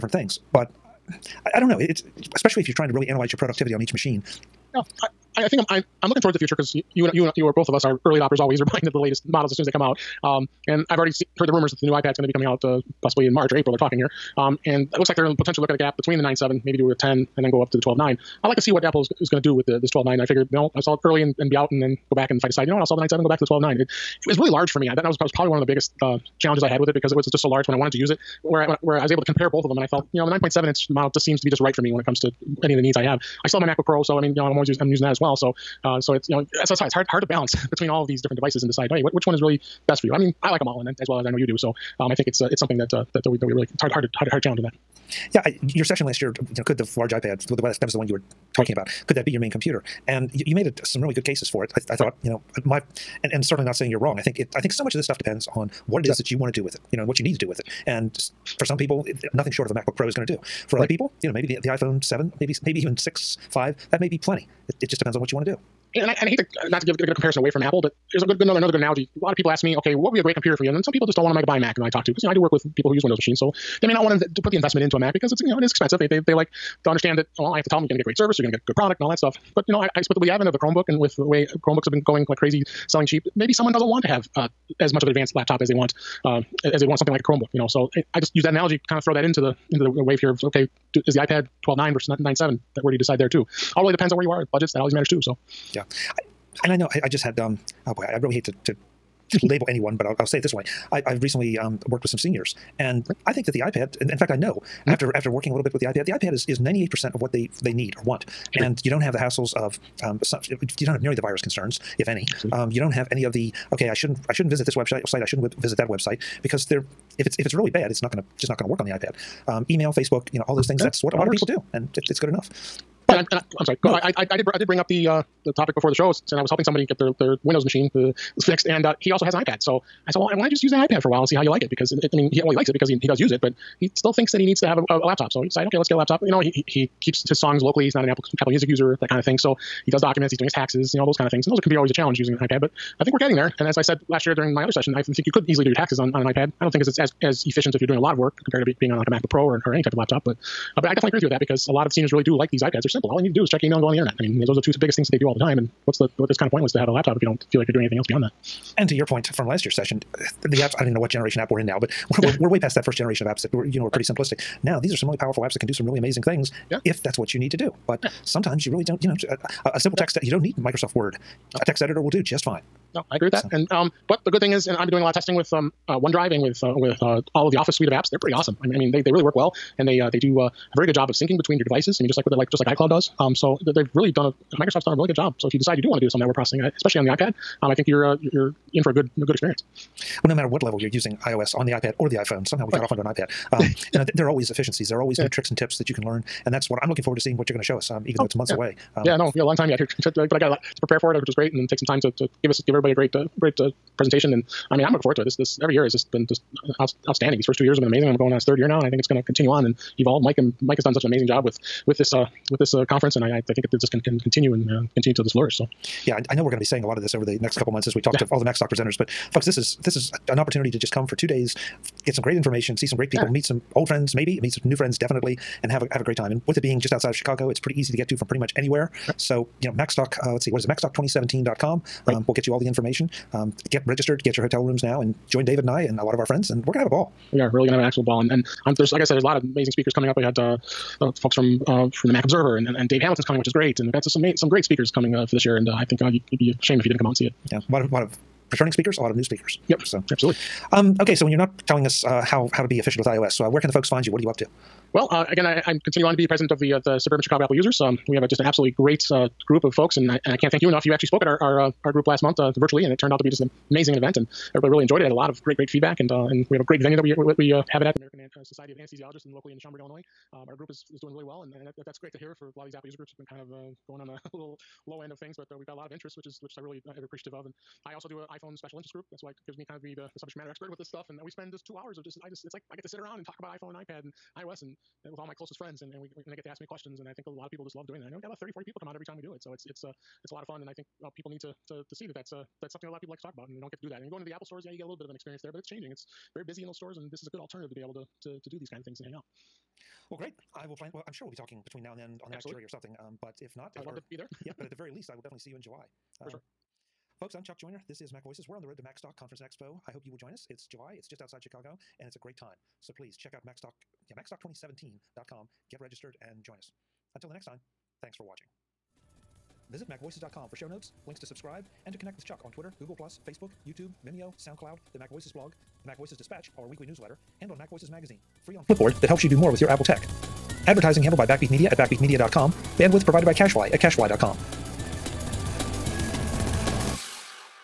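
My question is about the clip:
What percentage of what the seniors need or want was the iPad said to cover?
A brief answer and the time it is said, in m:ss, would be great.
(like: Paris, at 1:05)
98, at 1:46.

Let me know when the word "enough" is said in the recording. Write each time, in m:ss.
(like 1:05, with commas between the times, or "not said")
2:02, 4:20.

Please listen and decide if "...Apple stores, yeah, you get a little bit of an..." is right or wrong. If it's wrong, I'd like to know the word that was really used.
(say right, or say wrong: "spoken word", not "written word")
right.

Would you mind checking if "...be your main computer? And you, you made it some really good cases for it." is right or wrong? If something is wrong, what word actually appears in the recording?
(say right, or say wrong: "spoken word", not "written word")
right.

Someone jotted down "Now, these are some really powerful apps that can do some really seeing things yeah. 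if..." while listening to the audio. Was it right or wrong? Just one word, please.
wrong.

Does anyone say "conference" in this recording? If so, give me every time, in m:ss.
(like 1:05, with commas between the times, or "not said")
3:32, 5:09.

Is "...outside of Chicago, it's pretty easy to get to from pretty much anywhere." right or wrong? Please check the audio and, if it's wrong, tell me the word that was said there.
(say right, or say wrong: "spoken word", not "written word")
right.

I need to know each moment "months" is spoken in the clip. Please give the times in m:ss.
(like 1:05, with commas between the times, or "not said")
3:18, 3:37, 4:22.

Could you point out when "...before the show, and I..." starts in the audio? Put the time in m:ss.
2:05.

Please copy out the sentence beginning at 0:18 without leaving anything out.
I like to see what Apple is, is going to do with the, this 12.9.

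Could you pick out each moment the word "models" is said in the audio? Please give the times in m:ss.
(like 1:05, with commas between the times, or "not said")
0:09, 0:30.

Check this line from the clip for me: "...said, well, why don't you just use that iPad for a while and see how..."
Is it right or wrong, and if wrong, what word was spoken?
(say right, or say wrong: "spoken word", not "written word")
right.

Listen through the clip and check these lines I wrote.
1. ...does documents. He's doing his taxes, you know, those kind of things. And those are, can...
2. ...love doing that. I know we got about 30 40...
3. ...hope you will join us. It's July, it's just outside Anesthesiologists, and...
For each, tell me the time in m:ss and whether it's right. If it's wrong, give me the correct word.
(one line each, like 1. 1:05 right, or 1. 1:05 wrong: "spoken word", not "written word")
1. 2:19 right
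2. 4:47 right
3. 5:09 wrong: "Chicago", not "Anesthesiologists".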